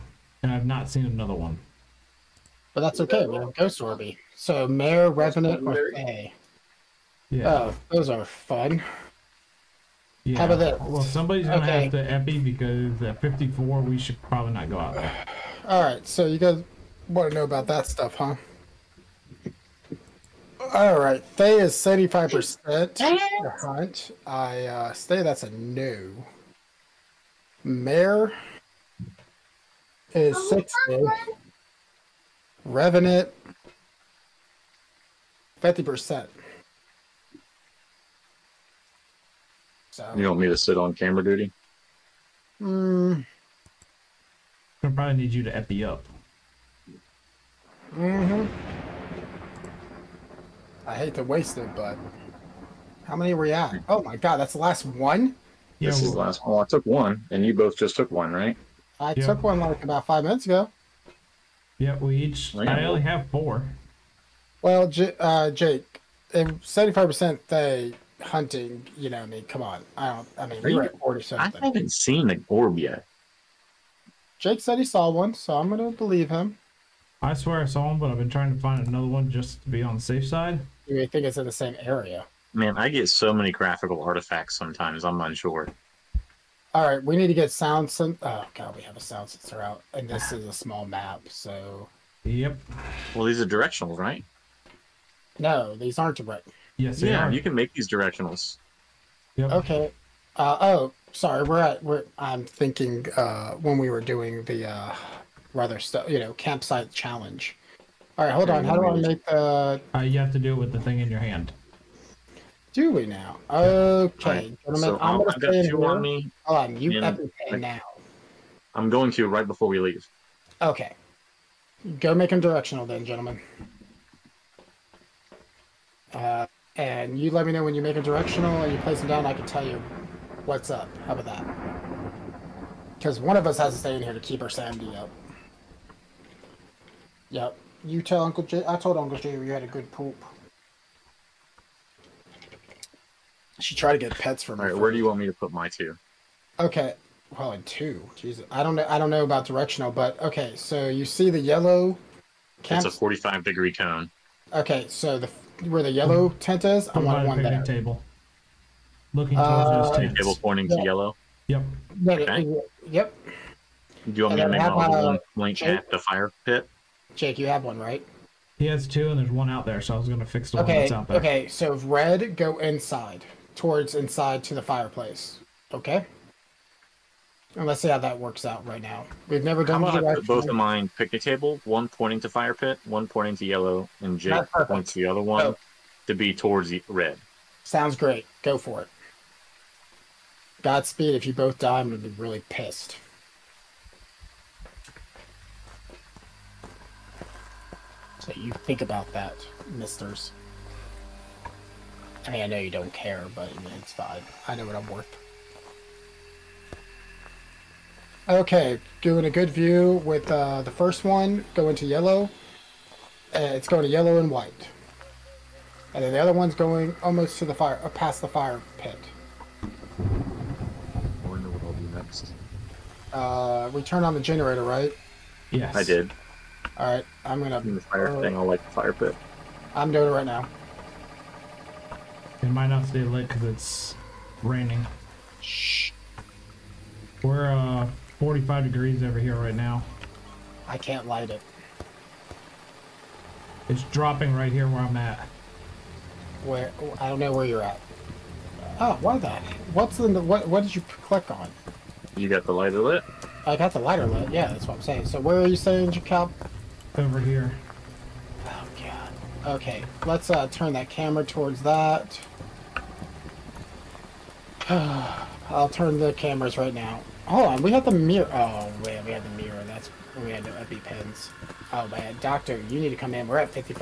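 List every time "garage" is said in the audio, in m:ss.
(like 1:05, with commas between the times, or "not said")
not said.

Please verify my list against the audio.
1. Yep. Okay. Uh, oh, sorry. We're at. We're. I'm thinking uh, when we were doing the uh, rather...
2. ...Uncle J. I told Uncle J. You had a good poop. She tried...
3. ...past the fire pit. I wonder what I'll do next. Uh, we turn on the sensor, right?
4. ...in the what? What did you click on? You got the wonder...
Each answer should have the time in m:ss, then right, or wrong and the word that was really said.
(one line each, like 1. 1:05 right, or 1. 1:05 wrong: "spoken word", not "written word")
1. 1:39 right
2. 2:18 right
3. 3:37 wrong: "generator", not "sensor"
4. 4:10 wrong: "lighter", not "wonder".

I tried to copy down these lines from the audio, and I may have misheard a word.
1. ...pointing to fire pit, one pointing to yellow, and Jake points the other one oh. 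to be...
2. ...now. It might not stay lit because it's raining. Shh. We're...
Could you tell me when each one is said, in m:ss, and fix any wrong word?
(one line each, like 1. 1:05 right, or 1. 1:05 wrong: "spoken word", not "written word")
1. 3:01 right
2. 3:50 right.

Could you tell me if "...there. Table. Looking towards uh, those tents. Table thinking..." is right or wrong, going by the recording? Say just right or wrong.
wrong.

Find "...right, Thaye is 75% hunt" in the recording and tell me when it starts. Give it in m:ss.
0:21.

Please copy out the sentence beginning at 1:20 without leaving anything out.
You think it's in the same area?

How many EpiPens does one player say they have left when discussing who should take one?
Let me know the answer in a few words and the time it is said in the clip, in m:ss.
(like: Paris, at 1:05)
4, at 1:03.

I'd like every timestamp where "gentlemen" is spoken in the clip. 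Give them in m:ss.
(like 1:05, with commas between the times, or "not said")
1:54, 2:03.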